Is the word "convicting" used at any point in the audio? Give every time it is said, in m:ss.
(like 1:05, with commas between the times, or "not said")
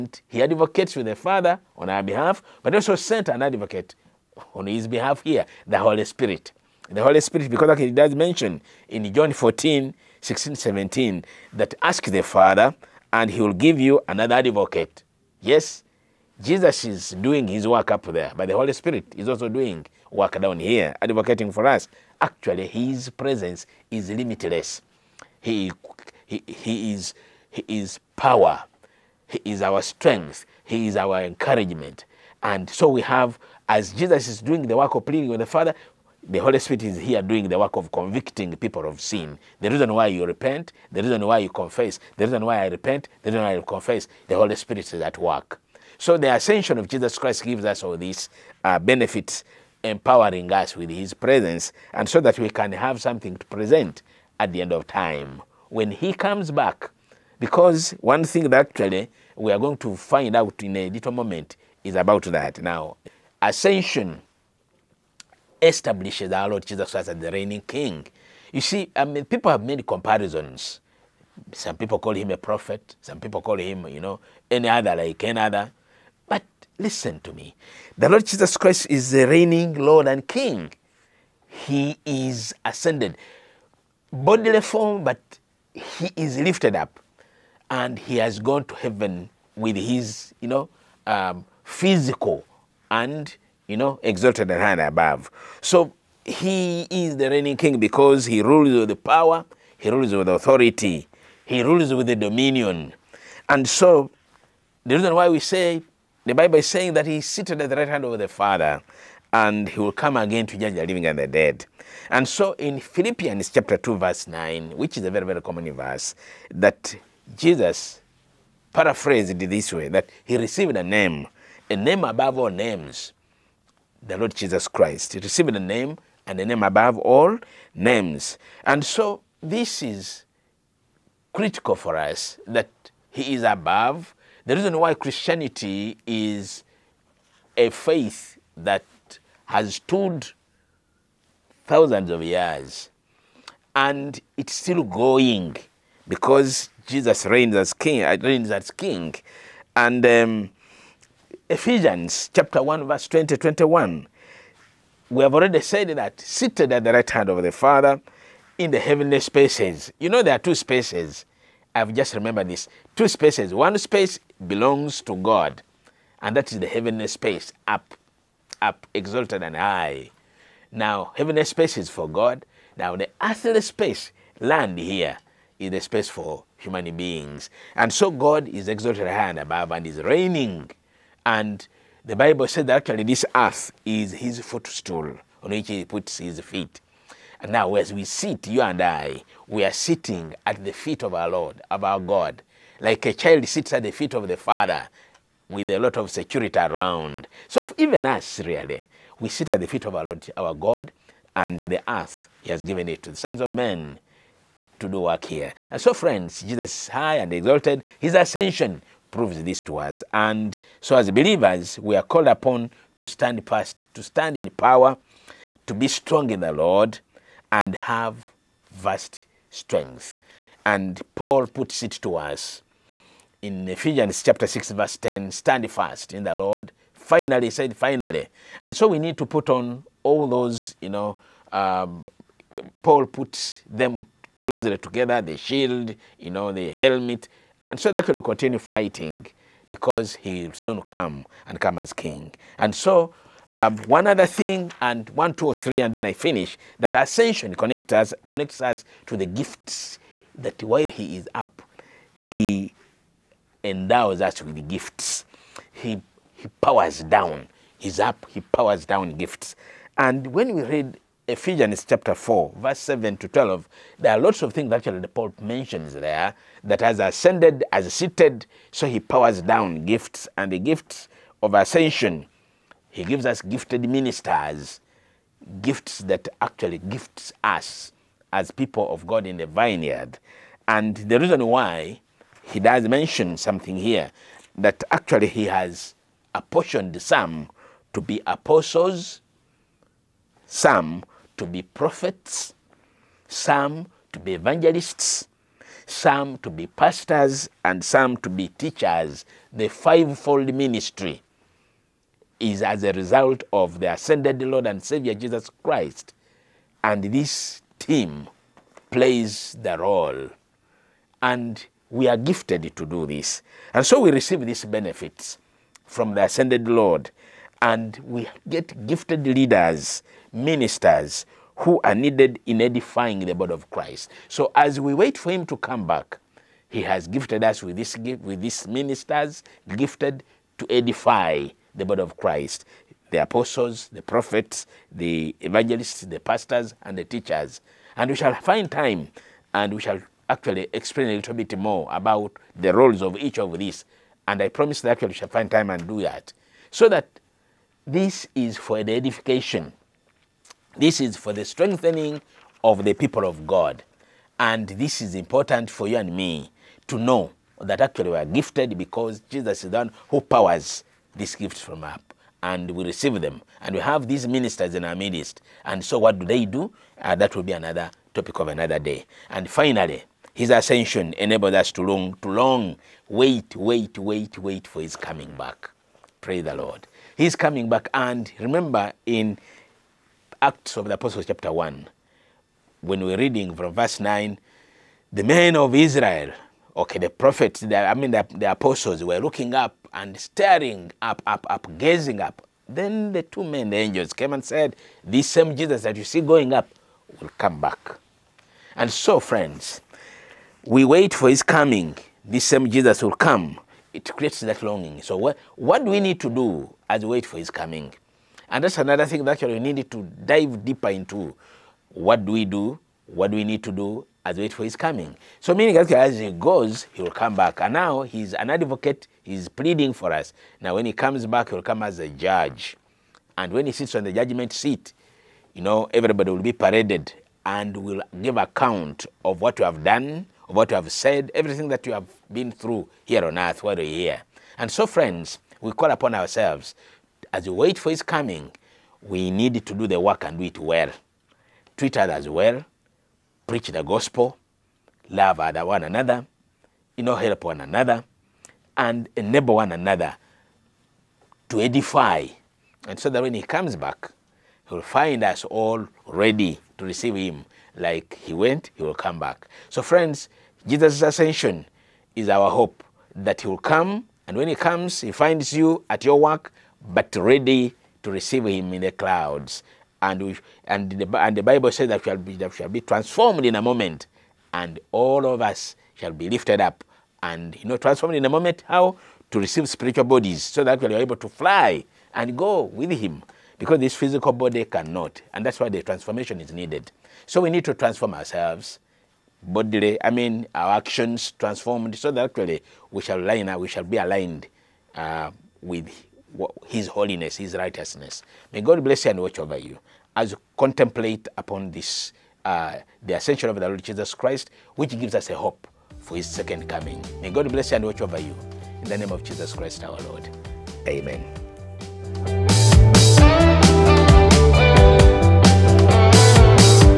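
0:37.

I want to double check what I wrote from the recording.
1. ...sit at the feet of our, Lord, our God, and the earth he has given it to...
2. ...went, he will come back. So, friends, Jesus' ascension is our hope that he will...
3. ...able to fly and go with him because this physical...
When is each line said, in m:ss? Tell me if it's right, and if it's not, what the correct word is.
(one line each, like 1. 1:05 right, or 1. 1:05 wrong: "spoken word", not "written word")
1. 3:19 right
2. 7:38 right
3. 8:00 right.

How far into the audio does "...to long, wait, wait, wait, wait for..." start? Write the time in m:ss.
6:12.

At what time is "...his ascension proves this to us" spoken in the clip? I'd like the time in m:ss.
3:27.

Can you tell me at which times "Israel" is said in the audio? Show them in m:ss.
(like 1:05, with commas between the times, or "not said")
6:25.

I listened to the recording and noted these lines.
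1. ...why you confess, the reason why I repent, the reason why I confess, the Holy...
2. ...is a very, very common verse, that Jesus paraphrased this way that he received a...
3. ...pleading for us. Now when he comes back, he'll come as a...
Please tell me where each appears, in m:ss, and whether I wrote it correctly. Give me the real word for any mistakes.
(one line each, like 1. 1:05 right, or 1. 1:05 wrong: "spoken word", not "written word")
1. 0:41 right
2. 1:54 right
3. 6:59 right.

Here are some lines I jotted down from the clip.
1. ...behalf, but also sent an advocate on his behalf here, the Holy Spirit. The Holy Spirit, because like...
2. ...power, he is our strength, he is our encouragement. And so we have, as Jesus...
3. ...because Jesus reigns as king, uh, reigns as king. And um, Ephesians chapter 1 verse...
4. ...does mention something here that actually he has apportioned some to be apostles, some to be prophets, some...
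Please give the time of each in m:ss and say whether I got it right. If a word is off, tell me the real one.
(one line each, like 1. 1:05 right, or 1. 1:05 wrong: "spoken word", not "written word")
1. 0:02 right
2. 0:28 right
3. 2:26 right
4. 4:42 right.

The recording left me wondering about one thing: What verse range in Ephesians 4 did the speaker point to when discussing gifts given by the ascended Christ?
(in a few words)
7 to 12.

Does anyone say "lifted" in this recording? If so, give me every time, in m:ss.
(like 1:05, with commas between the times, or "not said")
1:26, 7:56.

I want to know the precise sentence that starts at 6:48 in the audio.
And that's another thing that actually we need to dive deeper into.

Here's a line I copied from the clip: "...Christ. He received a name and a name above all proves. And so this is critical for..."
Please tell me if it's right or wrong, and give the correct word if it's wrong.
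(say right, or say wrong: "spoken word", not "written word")
wrong: "names", not "proves".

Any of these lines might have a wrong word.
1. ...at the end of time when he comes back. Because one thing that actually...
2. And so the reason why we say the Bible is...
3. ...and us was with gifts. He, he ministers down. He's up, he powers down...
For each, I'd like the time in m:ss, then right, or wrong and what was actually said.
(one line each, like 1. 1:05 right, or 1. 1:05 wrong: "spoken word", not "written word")
1. 0:54 right
2. 1:43 right
3. 4:13 wrong: "powers", not "ministers".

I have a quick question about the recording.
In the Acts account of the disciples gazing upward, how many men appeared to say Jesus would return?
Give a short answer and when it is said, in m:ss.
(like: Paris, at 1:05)
2, at 6:33.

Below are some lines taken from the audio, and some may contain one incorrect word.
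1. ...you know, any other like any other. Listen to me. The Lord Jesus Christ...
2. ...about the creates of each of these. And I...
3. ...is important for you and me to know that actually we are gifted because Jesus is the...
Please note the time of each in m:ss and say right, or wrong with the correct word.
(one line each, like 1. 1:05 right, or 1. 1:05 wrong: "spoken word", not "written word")
1. 1:13 right
2. 5:41 wrong: "roles", not "creates"
3. 5:55 right.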